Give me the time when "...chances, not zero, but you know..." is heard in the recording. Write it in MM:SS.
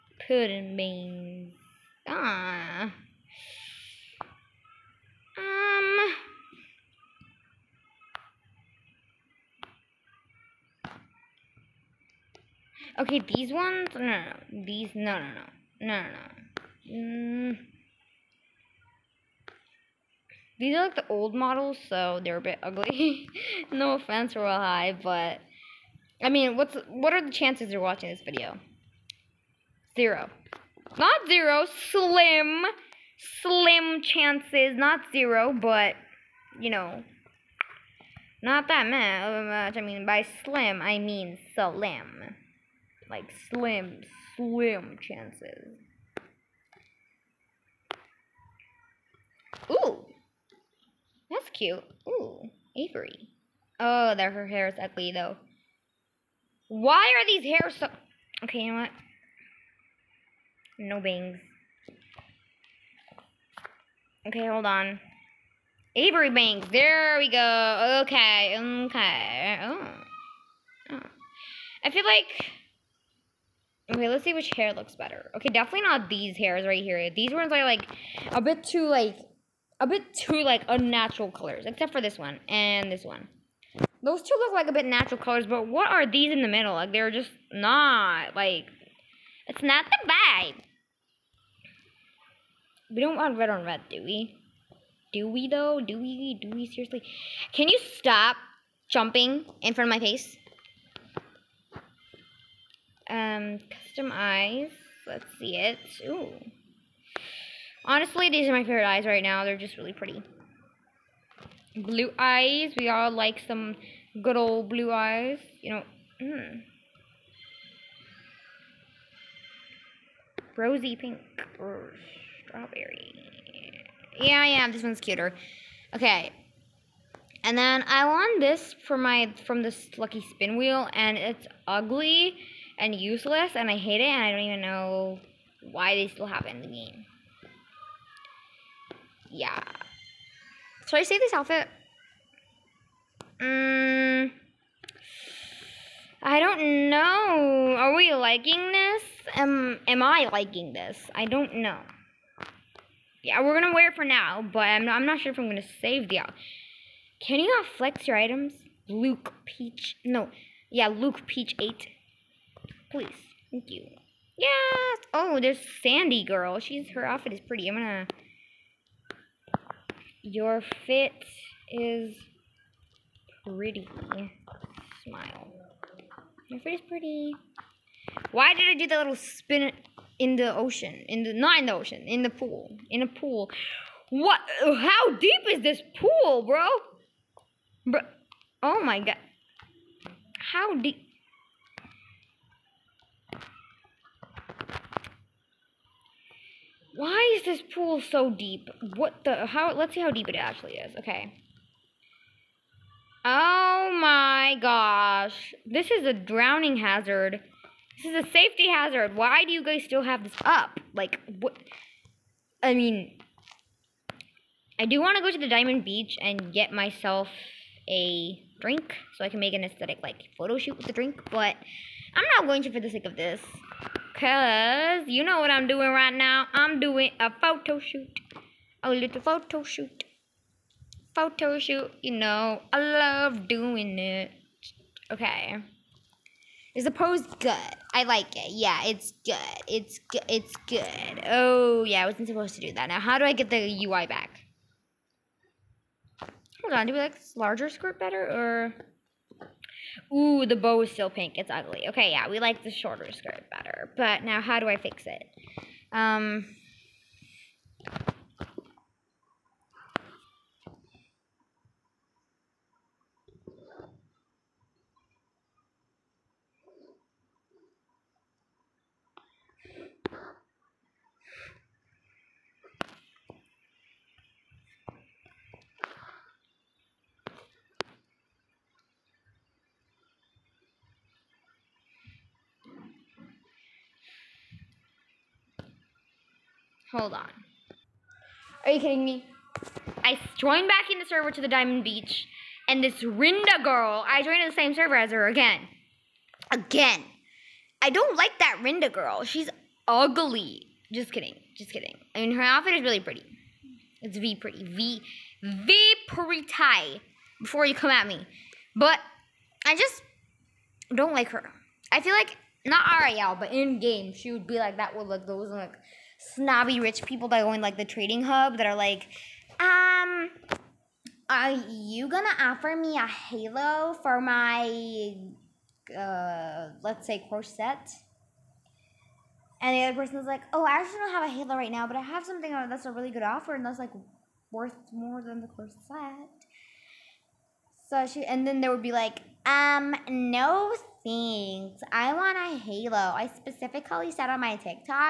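00:34.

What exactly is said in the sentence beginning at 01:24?
Those two look like a bit natural colors, but what are these in the middle?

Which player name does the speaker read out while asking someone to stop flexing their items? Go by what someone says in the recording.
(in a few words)
Luke Peach 8.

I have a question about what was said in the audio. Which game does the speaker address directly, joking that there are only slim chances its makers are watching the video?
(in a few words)
Royal High.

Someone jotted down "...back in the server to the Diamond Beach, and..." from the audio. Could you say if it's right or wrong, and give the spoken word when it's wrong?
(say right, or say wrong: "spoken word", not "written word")
right.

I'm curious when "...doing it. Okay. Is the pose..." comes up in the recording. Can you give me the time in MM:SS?
03:53.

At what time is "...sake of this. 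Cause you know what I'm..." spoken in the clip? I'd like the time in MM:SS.
03:42.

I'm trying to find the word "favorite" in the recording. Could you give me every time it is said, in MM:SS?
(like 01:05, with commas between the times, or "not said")
01:48.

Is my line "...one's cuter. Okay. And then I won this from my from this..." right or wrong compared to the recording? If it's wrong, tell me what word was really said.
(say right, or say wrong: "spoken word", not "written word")
right.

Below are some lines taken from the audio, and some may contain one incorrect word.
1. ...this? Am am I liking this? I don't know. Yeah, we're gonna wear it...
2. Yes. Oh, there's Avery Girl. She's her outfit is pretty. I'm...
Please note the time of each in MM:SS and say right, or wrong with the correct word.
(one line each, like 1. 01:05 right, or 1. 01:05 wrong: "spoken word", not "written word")
1. 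02:28 right
2. 02:44 wrong: "Sandy", not "Avery".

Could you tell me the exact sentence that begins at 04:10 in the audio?
Ooh, the bow is still pink.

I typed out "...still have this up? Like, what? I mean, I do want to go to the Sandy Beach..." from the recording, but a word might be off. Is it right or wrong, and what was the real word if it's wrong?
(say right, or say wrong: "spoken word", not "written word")
wrong: "Diamond", not "Sandy".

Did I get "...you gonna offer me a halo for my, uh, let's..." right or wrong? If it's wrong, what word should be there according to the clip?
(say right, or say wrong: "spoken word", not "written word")
right.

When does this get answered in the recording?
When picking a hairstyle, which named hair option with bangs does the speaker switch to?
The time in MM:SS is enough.
01:05.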